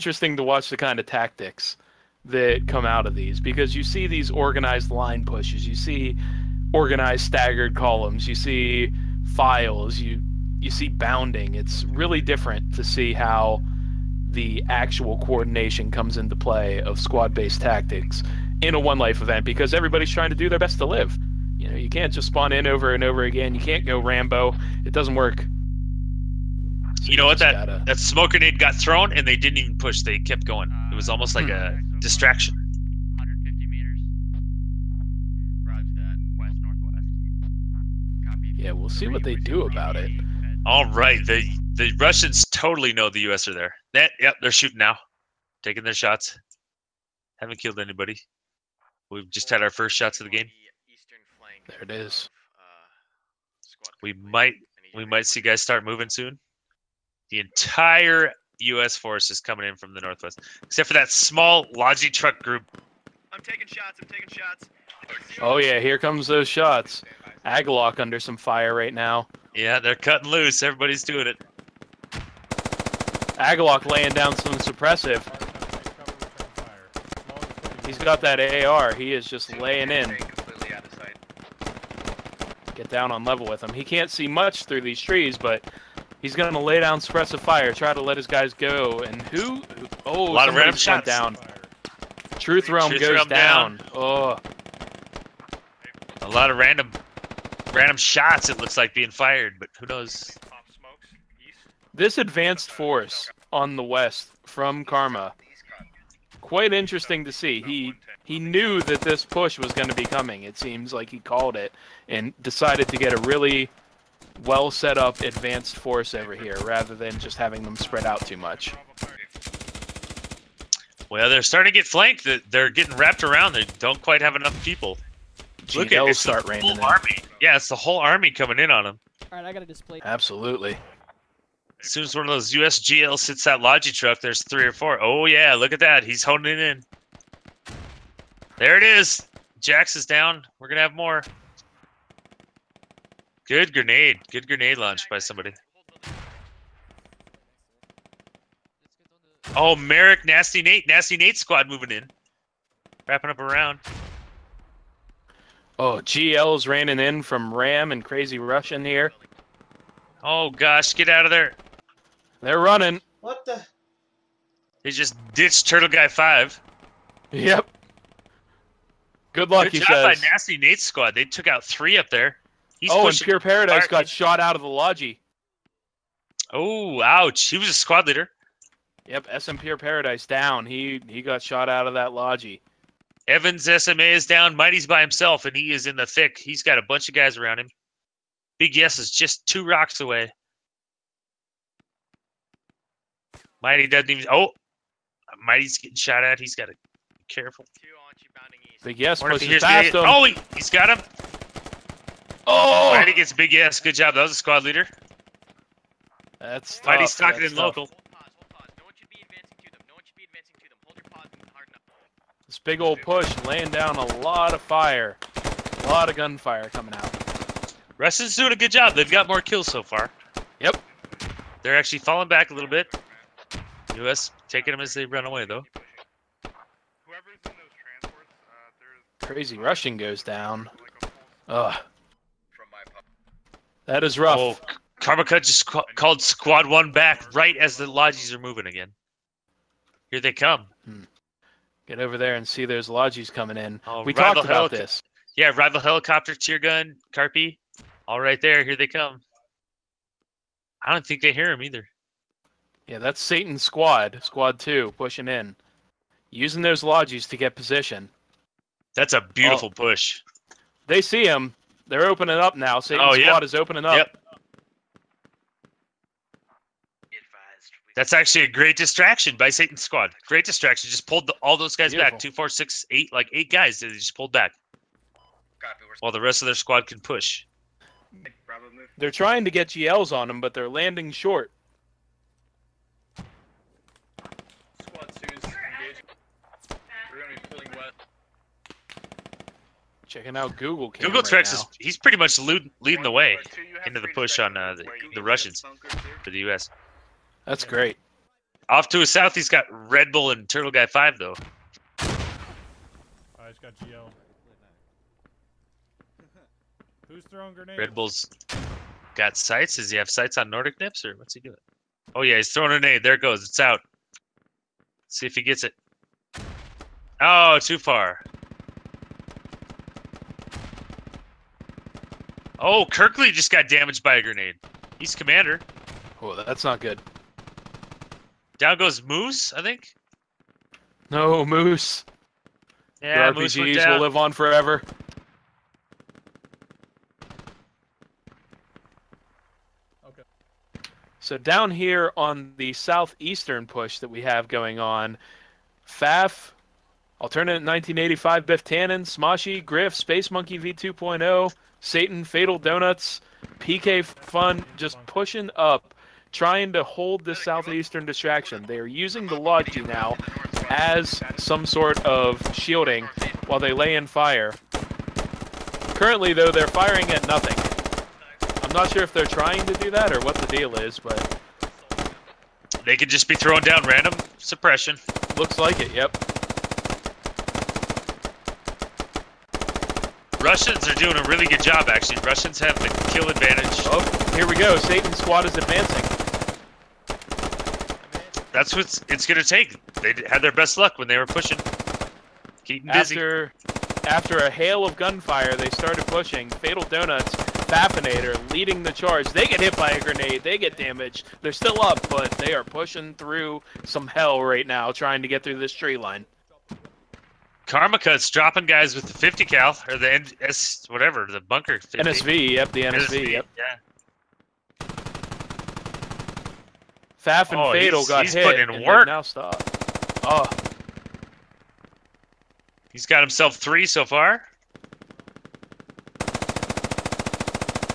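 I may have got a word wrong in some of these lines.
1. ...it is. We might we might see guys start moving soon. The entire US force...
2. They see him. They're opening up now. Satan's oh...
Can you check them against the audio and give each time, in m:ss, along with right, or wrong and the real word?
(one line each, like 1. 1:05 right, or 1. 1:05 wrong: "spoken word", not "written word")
1. 0:51 right
2. 4:20 right.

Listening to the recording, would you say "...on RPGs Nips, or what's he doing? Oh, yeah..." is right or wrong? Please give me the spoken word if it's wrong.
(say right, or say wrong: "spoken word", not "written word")
wrong: "Nordic", not "RPGs".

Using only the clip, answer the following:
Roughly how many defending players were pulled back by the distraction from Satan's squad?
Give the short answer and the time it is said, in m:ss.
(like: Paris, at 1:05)
8, at 4:33.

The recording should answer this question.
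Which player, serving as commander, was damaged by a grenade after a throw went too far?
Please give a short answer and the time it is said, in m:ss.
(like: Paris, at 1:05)
Kirkley, at 5:22.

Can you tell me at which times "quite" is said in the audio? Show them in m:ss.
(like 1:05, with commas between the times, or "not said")
1:46, 2:04.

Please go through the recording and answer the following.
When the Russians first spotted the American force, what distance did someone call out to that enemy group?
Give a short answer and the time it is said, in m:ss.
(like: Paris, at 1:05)
150 meters, at 0:33.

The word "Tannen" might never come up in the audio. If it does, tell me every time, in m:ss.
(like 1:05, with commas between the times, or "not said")
5:48.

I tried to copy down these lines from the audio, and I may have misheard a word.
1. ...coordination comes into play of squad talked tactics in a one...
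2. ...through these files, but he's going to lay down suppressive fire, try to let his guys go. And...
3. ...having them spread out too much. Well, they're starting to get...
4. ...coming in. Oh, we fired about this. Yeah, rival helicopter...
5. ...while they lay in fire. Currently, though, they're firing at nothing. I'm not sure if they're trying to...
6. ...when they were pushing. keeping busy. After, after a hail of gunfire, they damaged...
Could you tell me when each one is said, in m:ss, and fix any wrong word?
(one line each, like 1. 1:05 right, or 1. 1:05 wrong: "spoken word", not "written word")
1. 0:15 wrong: "based", not "talked"
2. 1:24 wrong: "trees", not "files"
3. 1:57 right
4. 4:03 wrong: "talked", not "fired"
5. 6:03 right
6. 6:30 wrong: "started", not "damaged".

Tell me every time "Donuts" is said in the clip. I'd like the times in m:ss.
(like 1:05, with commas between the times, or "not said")
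5:52, 6:36.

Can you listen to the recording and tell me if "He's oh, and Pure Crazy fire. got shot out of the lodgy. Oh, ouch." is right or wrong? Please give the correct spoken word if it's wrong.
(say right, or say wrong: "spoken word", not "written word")
wrong: "Paradise", not "Crazy".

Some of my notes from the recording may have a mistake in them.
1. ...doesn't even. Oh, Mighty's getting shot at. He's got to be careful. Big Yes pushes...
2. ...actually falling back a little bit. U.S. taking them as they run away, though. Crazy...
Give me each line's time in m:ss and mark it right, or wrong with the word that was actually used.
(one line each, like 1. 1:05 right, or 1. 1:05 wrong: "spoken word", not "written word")
1. 3:13 right
2. 3:41 right.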